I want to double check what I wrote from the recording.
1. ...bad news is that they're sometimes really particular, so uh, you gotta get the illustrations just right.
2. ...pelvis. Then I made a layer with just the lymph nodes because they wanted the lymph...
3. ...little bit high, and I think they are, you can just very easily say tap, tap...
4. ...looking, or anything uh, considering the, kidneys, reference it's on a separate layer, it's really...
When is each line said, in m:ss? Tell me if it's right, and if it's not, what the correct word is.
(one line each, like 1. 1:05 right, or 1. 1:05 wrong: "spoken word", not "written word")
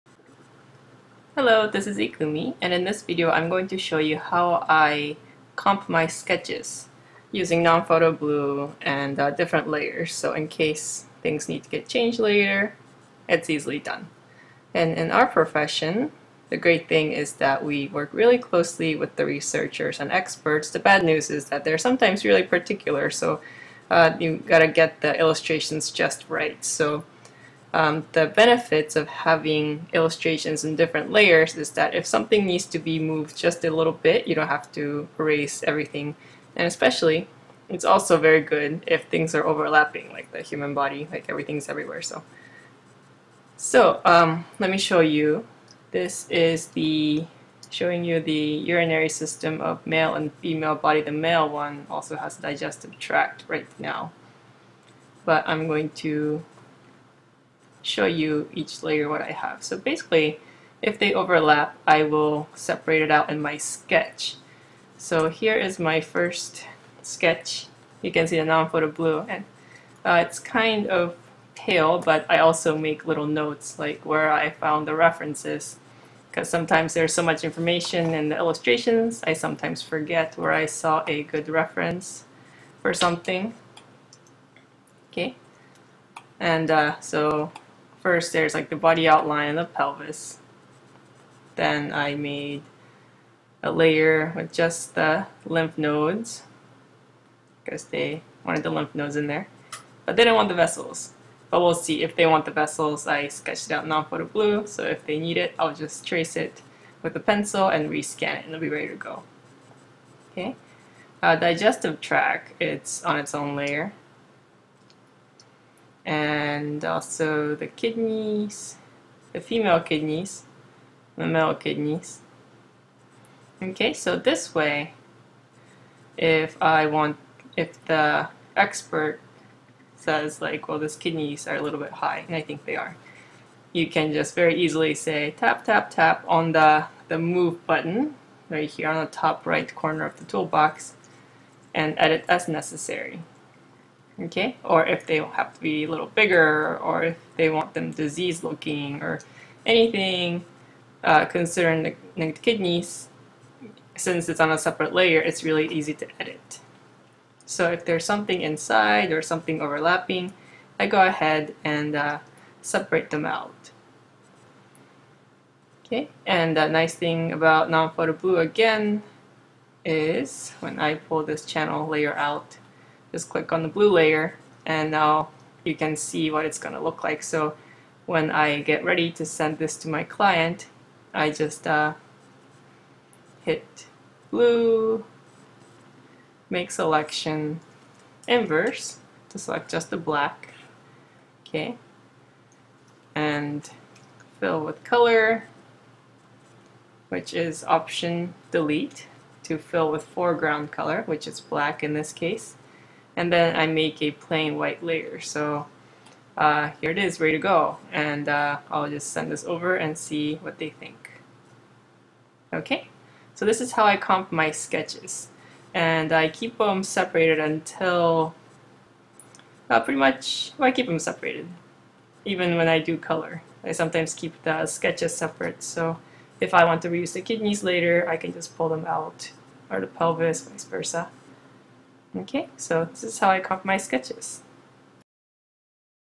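1. 0:20 right
2. 1:29 right
3. 2:11 right
4. 2:28 wrong: "since", not "reference".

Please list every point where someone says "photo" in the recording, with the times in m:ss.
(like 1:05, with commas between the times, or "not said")
0:07, 1:08, 1:43, 2:47.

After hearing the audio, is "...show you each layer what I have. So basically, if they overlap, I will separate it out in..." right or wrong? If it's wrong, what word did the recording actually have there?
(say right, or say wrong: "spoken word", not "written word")
right.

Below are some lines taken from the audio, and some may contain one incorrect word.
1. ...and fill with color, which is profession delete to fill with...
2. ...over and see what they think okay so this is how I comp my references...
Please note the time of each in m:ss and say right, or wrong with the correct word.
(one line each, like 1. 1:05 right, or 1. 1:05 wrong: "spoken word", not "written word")
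1. 3:13 wrong: "option", not "profession"
2. 3:29 wrong: "sketches", not "references".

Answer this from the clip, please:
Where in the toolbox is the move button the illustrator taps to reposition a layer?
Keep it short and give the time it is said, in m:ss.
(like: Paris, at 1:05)
top right corner, at 2:19.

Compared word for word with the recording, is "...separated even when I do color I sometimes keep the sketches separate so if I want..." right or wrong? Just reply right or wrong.
right.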